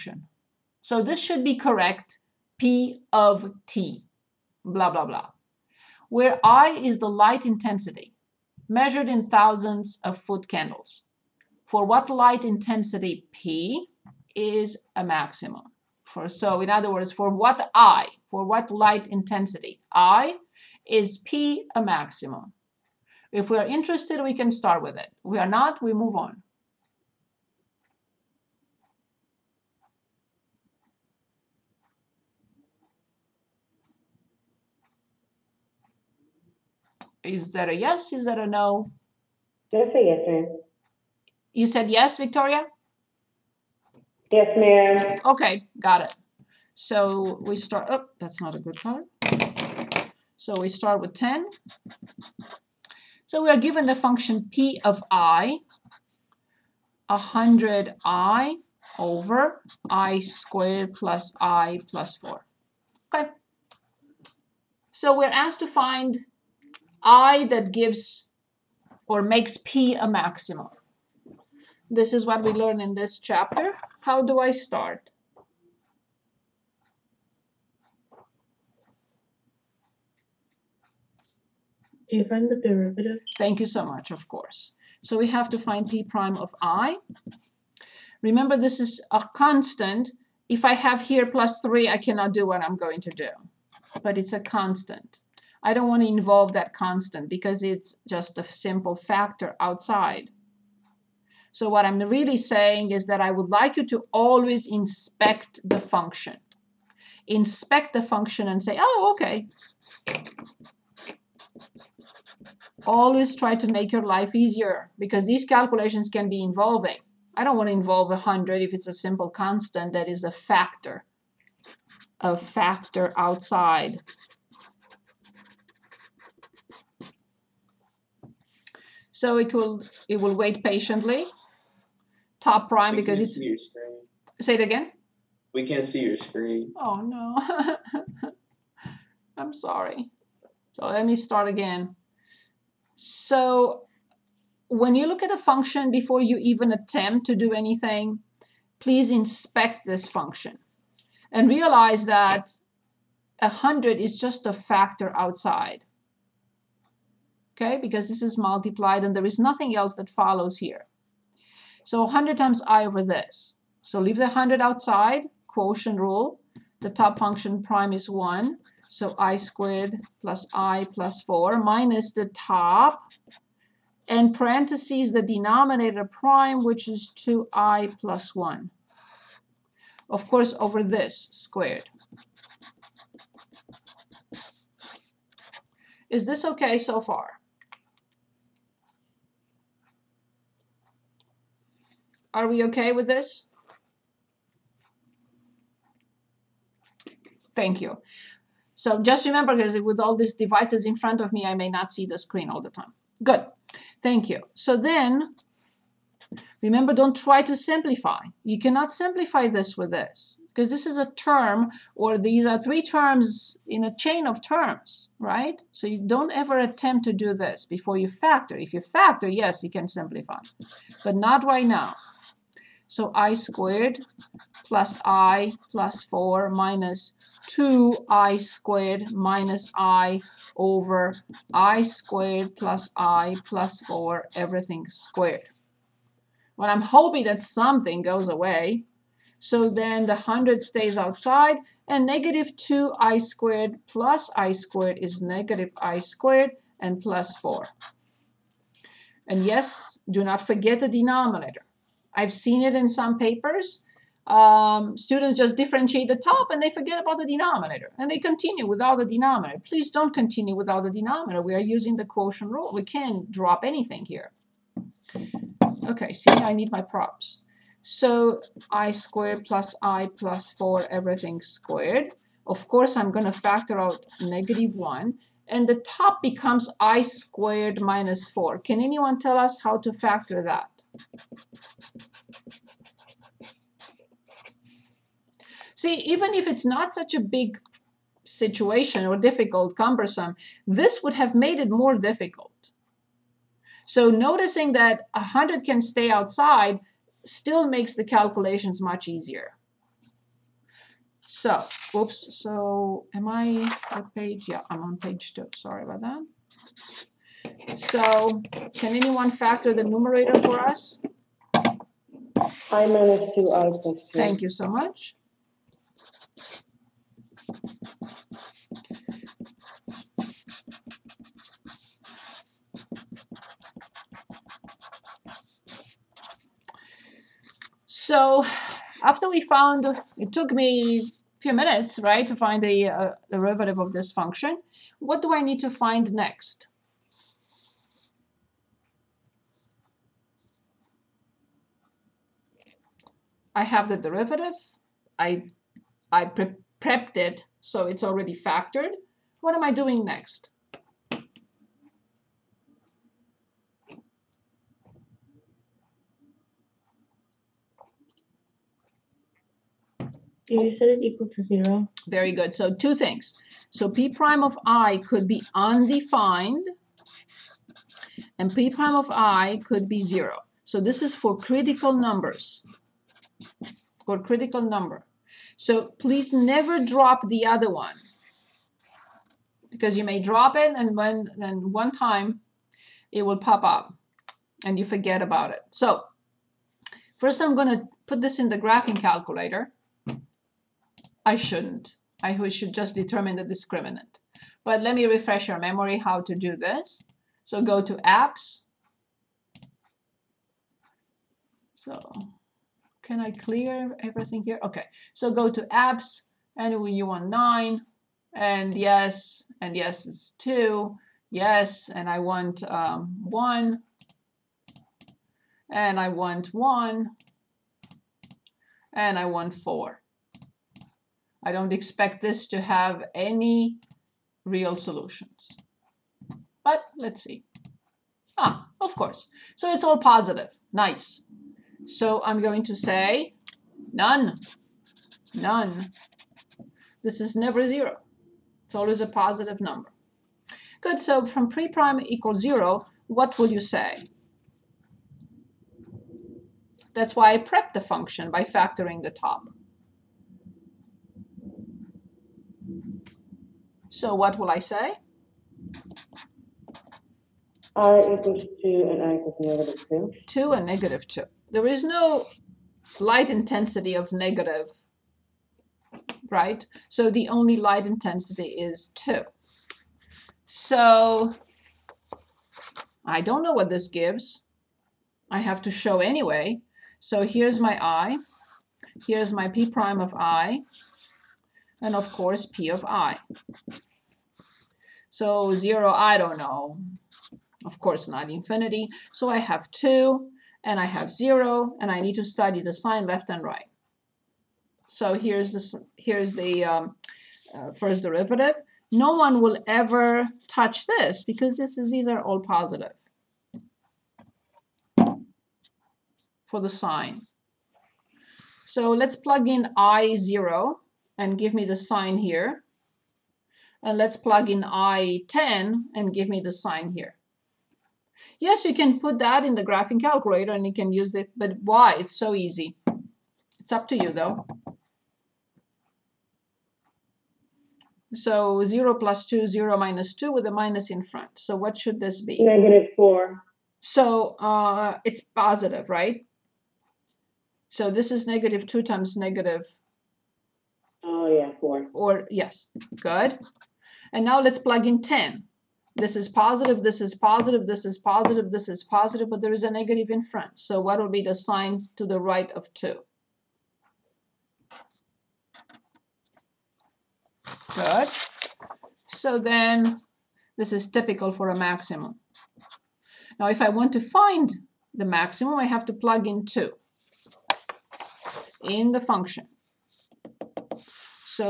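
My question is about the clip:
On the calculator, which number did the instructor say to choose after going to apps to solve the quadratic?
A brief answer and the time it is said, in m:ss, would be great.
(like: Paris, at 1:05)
9, at 6:47.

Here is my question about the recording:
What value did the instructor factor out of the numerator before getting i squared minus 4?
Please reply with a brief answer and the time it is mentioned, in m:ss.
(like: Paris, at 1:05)
negative 1, at 4:34.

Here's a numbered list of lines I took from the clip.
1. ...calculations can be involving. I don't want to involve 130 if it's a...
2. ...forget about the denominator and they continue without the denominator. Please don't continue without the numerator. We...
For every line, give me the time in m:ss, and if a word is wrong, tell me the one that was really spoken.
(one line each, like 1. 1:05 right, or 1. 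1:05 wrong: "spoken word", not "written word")
1. 1:55 wrong: "100", not "130"
2. 4:16 wrong: "denominator", not "numerator".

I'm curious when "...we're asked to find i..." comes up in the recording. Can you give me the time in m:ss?
1:05.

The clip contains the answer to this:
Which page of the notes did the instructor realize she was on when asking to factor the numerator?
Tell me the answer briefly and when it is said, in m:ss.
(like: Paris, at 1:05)
page two, at 5:04.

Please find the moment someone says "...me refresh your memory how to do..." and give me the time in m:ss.
6:34.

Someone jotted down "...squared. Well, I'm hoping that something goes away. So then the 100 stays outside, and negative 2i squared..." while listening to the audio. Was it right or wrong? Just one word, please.
right.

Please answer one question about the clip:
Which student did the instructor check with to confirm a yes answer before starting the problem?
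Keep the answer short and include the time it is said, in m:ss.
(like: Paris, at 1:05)
Victoria, at 0:42.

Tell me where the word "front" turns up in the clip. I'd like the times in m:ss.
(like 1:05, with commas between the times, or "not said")
3:20, 8:51, 9:10.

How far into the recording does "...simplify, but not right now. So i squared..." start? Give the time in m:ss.
3:39.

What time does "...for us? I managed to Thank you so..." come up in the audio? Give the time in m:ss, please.
5:10.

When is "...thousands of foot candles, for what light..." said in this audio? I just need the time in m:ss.
0:09.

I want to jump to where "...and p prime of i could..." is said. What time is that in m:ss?
6:08.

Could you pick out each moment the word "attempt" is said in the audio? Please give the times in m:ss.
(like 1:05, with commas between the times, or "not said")
2:26, 3:36.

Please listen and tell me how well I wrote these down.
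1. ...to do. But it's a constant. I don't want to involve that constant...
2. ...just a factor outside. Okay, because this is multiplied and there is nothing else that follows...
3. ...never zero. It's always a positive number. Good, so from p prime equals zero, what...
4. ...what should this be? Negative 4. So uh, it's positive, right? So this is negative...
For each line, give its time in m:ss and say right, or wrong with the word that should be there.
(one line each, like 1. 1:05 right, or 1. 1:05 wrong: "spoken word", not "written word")
1. 1:33 right
2. 2:34 right
3. 7:17 right
4. 8:51 right.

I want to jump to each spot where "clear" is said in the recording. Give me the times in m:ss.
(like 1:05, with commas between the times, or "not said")
6:43.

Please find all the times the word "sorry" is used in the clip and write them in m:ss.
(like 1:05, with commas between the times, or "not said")
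2:19, 5:05.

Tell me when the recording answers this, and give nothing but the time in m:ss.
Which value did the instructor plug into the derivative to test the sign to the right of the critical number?
8:34.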